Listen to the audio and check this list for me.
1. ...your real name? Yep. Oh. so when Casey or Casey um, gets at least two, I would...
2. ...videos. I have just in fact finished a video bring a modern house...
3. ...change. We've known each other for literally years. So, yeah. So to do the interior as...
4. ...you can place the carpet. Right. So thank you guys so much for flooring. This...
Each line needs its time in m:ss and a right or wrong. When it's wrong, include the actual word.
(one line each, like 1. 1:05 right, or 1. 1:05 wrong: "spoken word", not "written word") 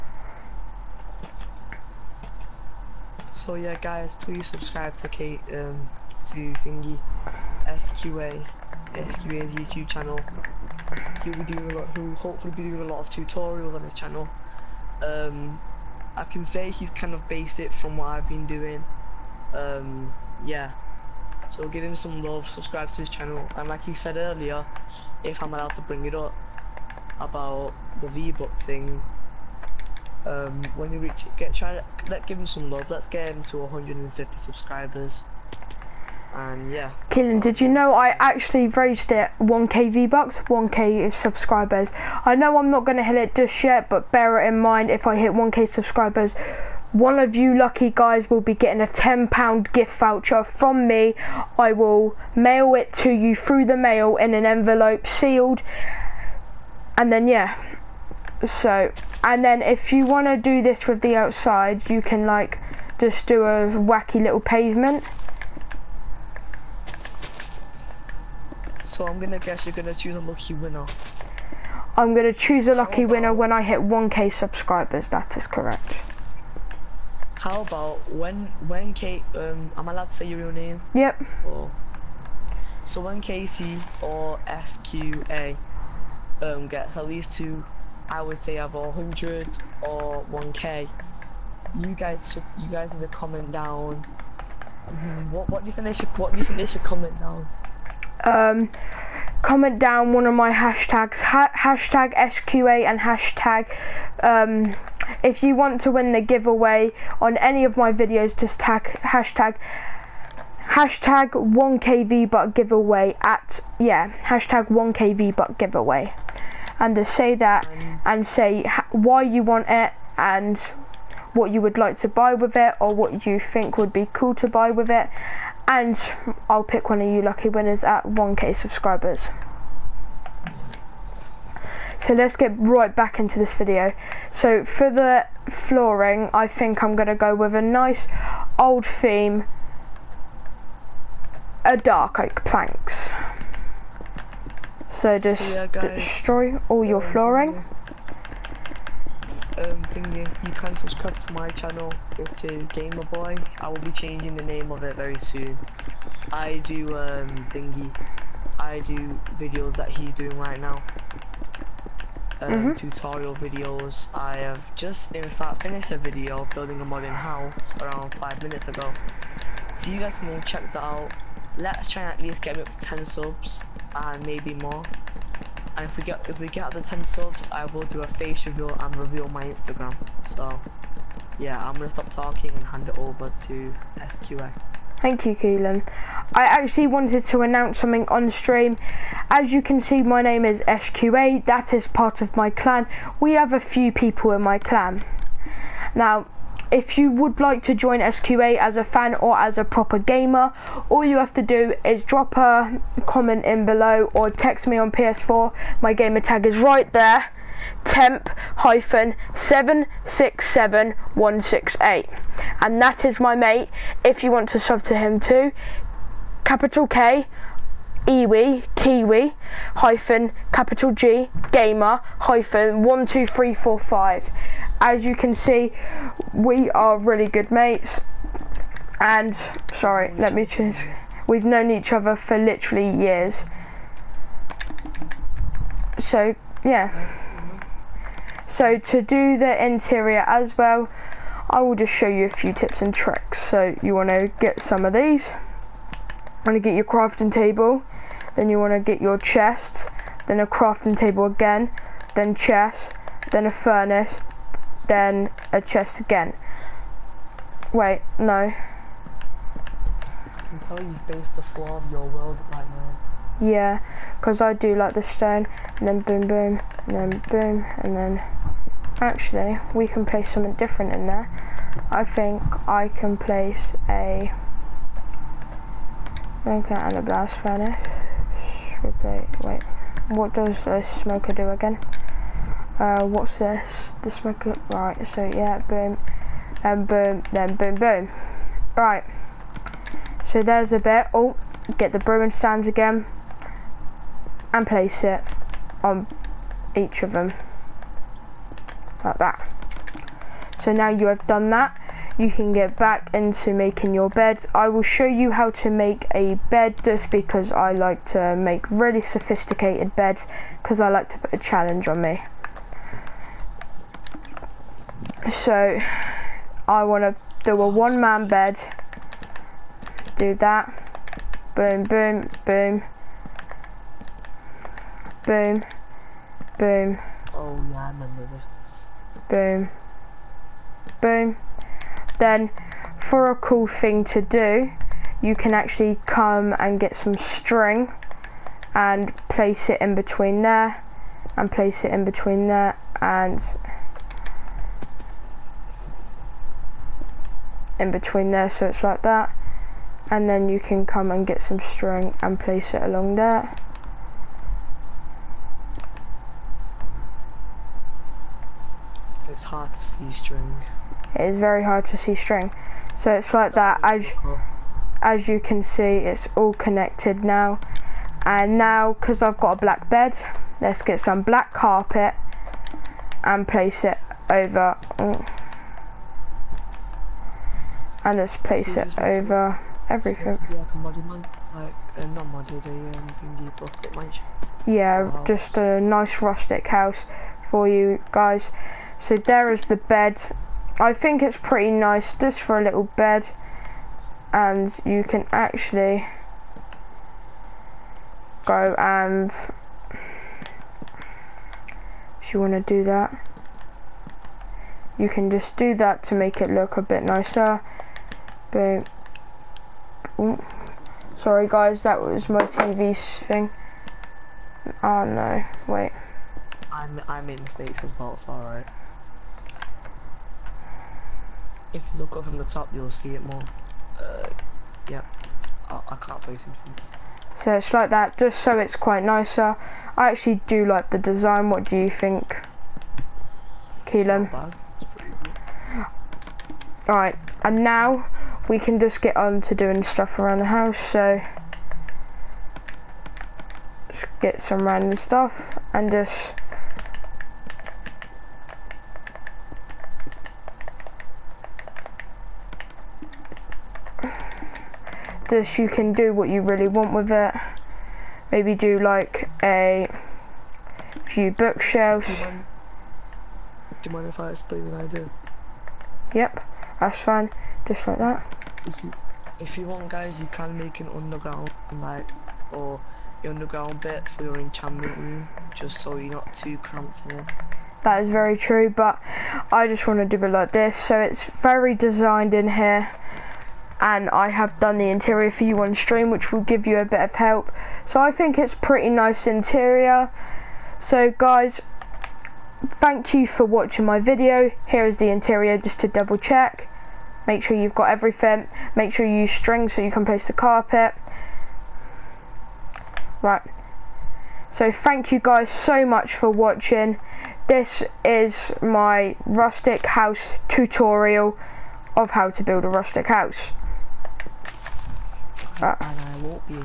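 1. 1:20 wrong: "SQA", not "Casey"
2. 2:43 wrong: "building", not "bring"
3. 3:50 right
4. 8:19 wrong: "watching", not "flooring".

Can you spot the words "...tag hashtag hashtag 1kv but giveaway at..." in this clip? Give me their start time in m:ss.
1:48.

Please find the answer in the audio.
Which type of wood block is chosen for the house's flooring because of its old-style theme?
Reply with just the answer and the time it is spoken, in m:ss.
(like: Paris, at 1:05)
dark oak planks, at 2:21.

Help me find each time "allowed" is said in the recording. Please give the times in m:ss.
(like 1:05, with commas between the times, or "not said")
0:25, 1:19.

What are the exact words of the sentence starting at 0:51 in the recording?
I will mail it to you through the mail in an envelope sealed.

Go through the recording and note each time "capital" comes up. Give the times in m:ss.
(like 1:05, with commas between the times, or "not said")
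3:36, 3:40.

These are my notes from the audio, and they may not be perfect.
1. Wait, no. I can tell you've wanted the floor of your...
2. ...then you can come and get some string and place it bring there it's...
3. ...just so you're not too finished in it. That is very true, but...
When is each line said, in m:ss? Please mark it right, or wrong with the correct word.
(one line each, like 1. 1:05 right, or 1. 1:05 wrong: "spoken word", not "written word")
1. 4:17 wrong: "based", not "wanted"
2. 5:50 wrong: "along", not "bring"
3. 7:55 wrong: "cramped", not "finished".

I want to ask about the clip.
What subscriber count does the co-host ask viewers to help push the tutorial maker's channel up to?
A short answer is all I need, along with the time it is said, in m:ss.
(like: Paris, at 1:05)
150, at 0:33.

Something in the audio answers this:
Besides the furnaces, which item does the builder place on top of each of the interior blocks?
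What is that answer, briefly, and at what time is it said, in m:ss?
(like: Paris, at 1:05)
brewing stands, at 4:51.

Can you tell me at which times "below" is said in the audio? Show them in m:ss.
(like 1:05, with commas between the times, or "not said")
3:23.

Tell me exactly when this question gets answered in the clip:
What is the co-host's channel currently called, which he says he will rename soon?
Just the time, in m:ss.
2:32.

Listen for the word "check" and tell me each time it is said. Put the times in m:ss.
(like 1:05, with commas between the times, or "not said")
2:50, 8:16.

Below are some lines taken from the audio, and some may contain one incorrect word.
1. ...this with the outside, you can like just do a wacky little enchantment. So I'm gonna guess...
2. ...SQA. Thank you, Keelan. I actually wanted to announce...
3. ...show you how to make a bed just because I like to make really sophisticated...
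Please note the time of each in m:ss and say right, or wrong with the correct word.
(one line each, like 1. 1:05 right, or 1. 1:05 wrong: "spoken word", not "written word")
1. 1:00 wrong: "pavement", not "enchantment"
2. 3:03 right
3. 5:04 right.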